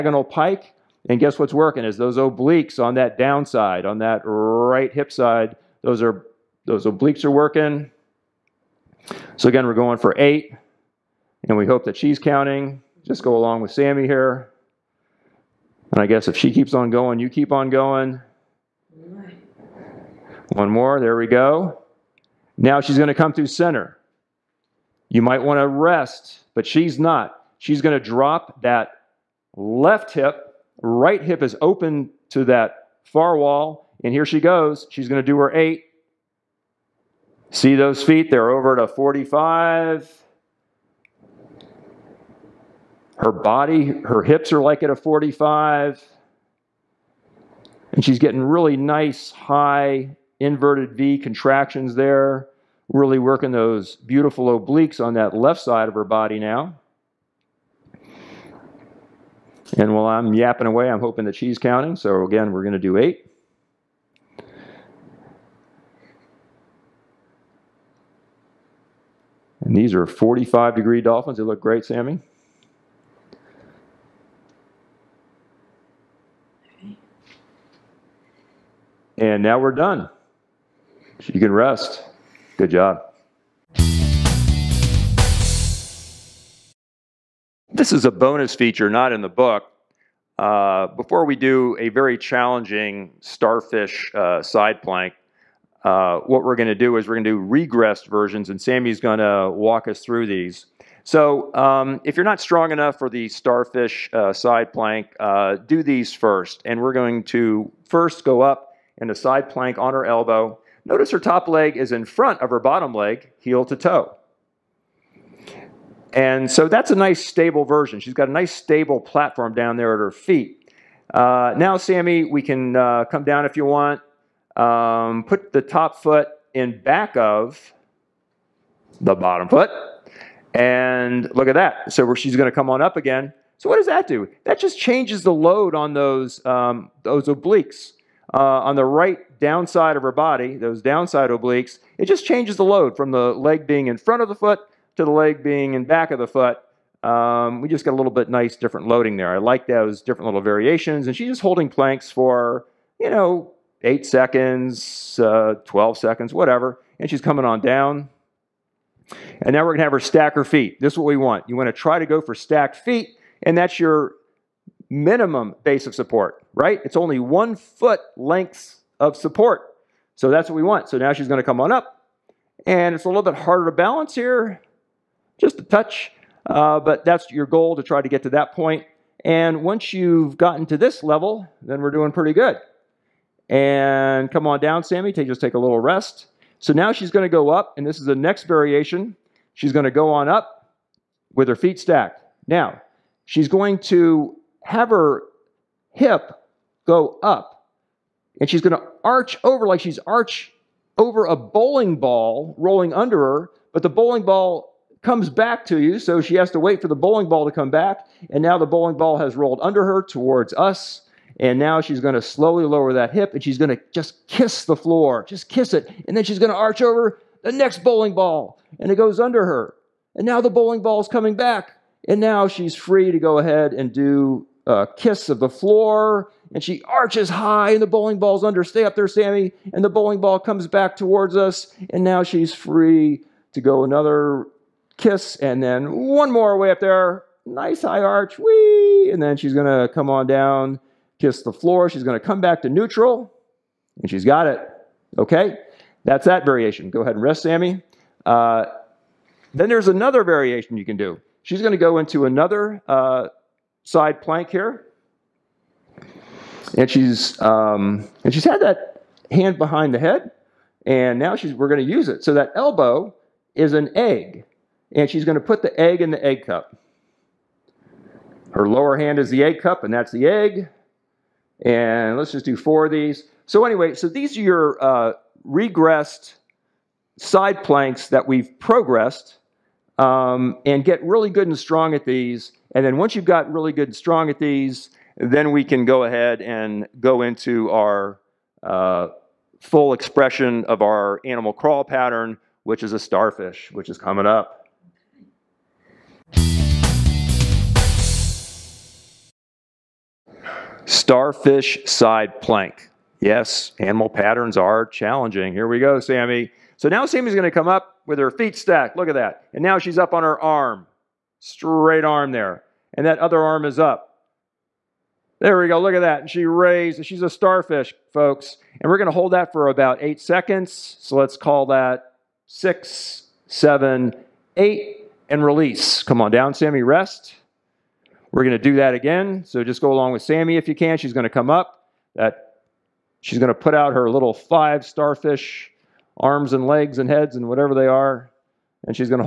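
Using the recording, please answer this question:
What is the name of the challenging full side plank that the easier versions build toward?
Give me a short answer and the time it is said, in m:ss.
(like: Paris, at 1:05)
starfish side plank, at 5:00.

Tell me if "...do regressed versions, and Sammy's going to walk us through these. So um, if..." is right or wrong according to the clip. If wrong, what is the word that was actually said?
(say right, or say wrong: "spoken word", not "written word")
right.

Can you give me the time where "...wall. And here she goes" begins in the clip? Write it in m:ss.
0:33.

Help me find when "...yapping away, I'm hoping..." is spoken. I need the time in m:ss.
1:00.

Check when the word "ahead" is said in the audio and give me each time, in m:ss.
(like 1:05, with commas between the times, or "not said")
3:43, 4:07, 4:46.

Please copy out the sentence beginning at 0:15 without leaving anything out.
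And I guess if she keeps on going, you keep on going.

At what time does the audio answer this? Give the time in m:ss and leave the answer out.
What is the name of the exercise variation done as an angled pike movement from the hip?
1:10.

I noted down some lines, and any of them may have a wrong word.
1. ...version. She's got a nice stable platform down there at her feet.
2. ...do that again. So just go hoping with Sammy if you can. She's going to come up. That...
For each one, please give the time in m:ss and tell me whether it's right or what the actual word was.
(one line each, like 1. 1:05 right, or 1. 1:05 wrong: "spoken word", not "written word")
1. 1:57 right
2. 5:28 wrong: "along", not "hoping".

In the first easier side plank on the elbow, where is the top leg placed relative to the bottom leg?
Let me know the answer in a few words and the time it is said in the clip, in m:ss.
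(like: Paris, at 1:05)
heel to toe, at 1:53.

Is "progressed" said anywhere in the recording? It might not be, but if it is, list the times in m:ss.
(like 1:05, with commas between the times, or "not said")
4:38.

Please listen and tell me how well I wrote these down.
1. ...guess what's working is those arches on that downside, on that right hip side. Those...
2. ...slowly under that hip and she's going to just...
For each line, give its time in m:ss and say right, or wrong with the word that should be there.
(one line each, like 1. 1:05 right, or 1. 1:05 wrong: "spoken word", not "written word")
1. 0:01 wrong: "obliques", not "arches"
2. 3:32 wrong: "lower", not "under".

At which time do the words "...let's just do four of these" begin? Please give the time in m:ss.
4:32.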